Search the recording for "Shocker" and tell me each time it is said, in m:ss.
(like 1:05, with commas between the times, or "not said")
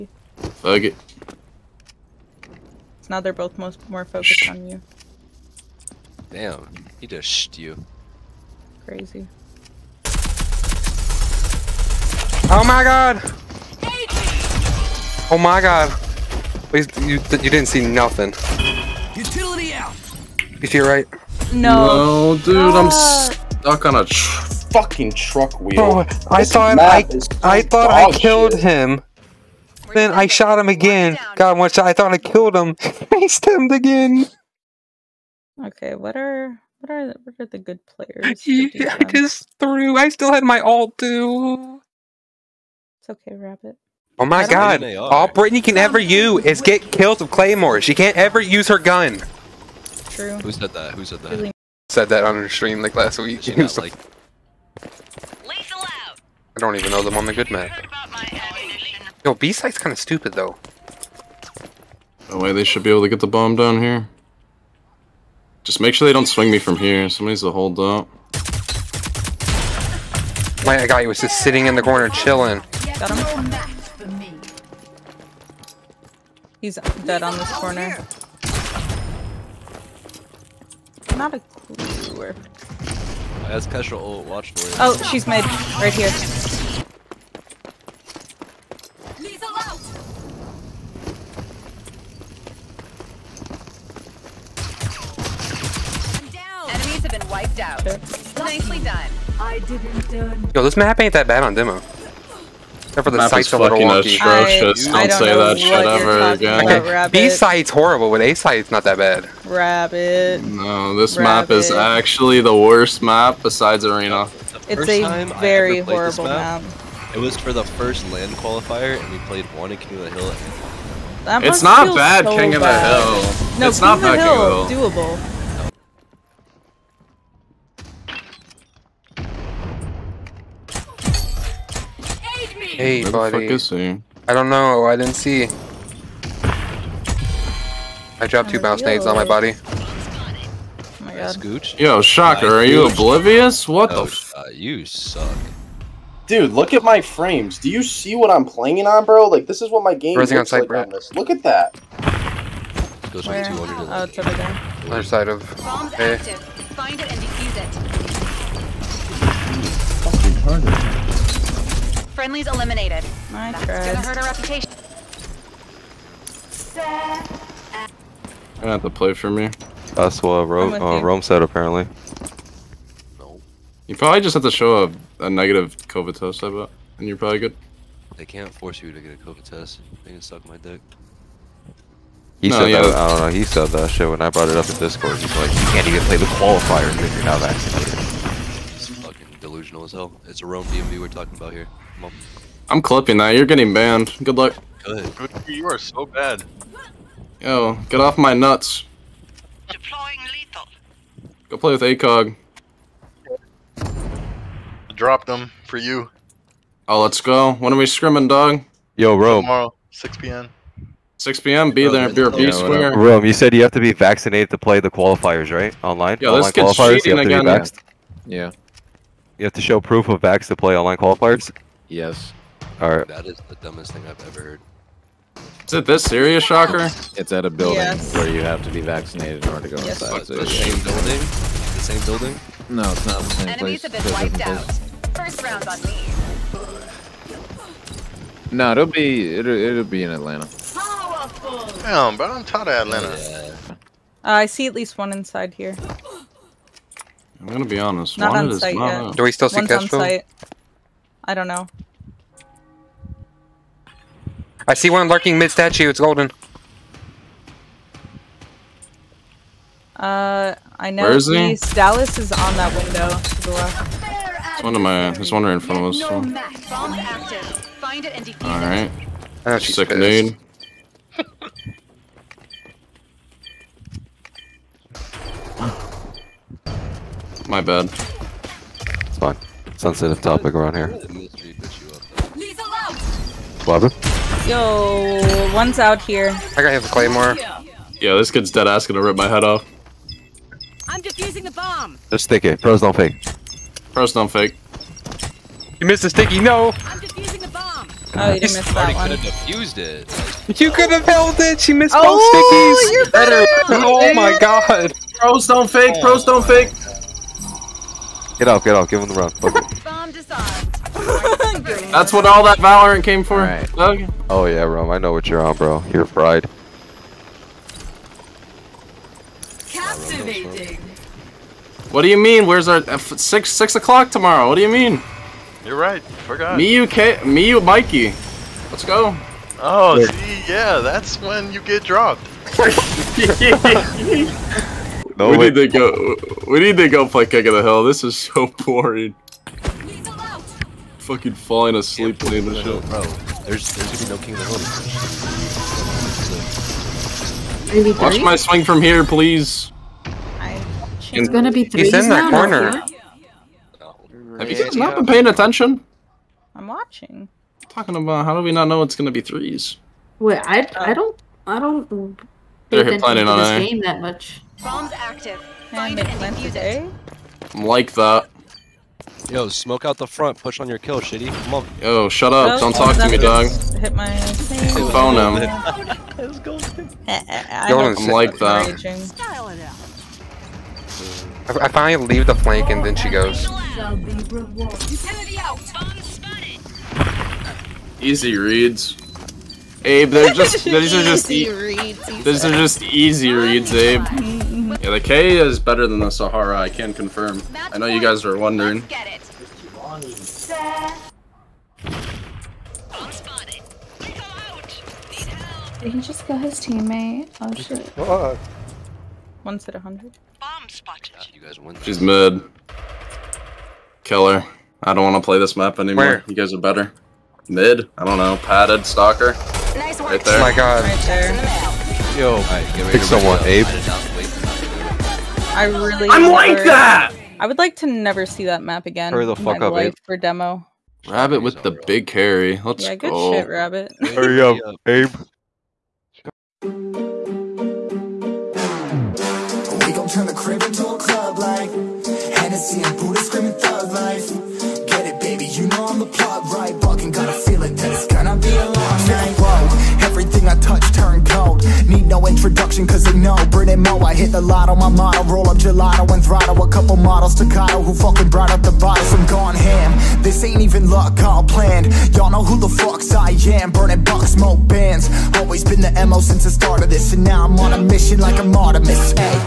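2:22, 3:46.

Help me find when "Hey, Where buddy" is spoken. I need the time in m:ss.
2:12.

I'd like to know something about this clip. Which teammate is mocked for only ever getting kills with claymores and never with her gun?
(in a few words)
Brittany.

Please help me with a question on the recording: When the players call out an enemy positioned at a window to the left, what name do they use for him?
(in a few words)
Dallas.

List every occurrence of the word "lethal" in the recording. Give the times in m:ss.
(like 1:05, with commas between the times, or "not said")
3:20.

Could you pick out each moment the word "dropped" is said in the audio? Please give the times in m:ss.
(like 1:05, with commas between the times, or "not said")
2:18, 3:24, 5:31.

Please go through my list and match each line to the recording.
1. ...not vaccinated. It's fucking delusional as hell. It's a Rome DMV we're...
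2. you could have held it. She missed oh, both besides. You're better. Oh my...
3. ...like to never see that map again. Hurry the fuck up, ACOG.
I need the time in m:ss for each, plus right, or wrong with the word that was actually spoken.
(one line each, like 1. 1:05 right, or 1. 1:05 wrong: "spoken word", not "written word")
1. 3:07 right
2. 5:00 wrong: "stickies", not "besides"
3. 7:07 wrong: "Abe", not "ACOG".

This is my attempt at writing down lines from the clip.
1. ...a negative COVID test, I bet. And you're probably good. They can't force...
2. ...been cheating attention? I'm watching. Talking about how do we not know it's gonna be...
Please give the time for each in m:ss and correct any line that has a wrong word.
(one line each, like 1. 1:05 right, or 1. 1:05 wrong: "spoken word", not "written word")
1. 2:55 right
2. 5:54 wrong: "paying", not "cheating".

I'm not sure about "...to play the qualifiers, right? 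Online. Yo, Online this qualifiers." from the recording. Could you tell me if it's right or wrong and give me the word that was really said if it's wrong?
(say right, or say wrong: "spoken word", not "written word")
right.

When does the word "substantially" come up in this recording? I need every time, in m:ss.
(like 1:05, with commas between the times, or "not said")
not said.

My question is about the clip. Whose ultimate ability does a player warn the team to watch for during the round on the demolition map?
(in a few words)
Kestrel.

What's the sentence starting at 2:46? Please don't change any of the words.
You're gonna have to play for me.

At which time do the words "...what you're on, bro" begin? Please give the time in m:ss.
5:15.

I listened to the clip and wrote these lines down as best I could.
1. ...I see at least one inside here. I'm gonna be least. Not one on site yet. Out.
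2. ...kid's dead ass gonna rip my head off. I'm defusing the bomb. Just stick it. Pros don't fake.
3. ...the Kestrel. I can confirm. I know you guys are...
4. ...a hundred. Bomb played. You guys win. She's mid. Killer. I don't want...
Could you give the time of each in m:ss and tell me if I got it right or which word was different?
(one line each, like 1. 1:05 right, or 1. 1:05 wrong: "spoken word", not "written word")
1. 4:04 wrong: "honest", not "least"
2. 4:48 right
3. 6:35 wrong: "Sahara", not "Kestrel"
4. 6:49 wrong: "spotted", not "played".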